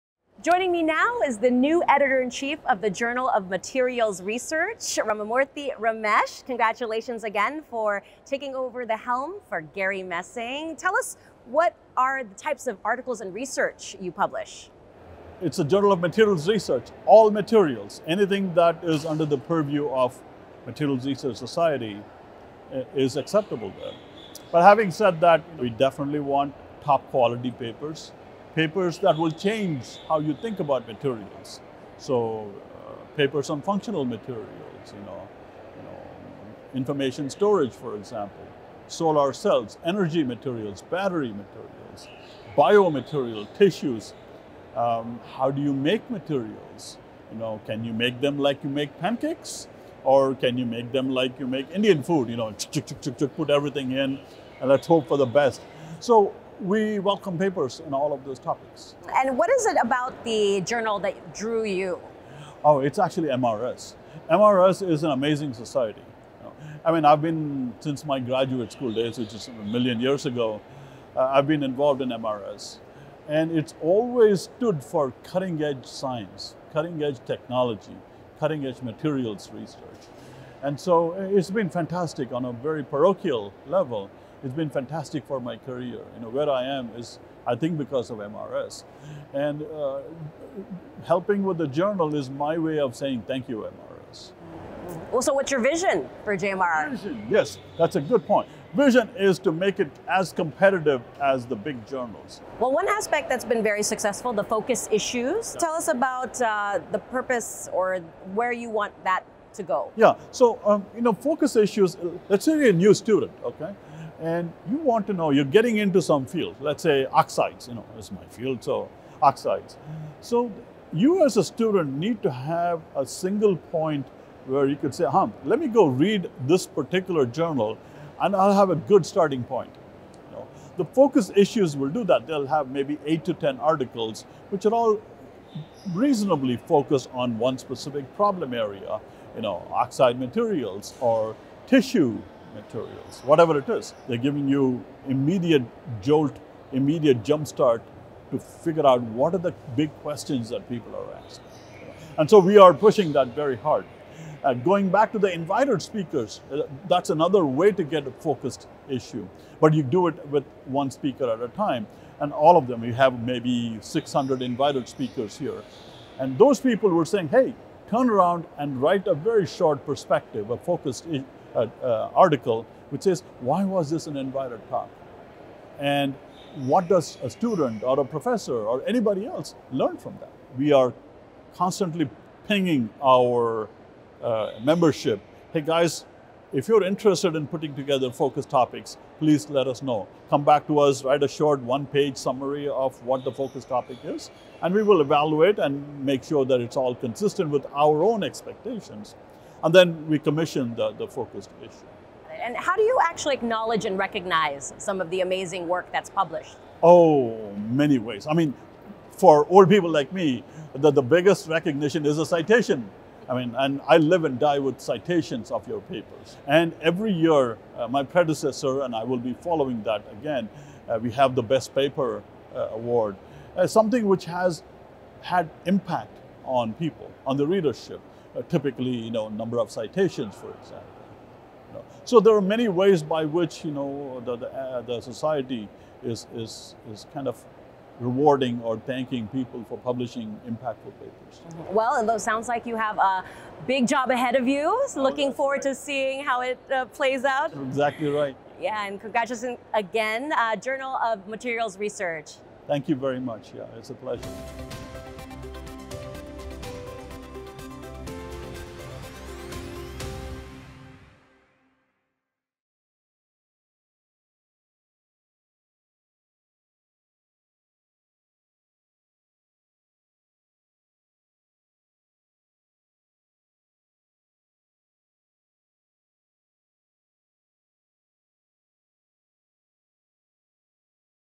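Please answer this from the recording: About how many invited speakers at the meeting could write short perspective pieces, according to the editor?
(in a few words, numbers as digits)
600.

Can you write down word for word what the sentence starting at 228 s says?
Uh, typically, you know, number of citations, for example.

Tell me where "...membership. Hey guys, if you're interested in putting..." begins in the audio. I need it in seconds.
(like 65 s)
184 s.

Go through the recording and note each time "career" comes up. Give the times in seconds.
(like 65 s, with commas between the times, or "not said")
85 s.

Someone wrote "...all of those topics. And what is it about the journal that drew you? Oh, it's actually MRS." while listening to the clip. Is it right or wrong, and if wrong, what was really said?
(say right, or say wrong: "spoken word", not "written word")
right.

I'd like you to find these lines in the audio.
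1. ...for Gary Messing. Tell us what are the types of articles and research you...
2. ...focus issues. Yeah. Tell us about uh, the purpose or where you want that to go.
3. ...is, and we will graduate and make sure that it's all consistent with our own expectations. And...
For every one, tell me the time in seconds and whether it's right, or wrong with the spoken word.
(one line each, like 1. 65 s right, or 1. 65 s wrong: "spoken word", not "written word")
1. 9 s right
2. 104 s right
3. 194 s wrong: "evaluate", not "graduate".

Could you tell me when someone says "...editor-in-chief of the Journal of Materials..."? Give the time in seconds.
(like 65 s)
1 s.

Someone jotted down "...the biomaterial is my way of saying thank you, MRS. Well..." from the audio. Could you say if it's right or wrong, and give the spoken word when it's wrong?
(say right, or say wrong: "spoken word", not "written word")
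wrong: "journal", not "biomaterial".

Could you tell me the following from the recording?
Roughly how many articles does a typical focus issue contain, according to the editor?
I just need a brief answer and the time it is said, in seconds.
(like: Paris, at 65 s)
8 to 10, at 133 s.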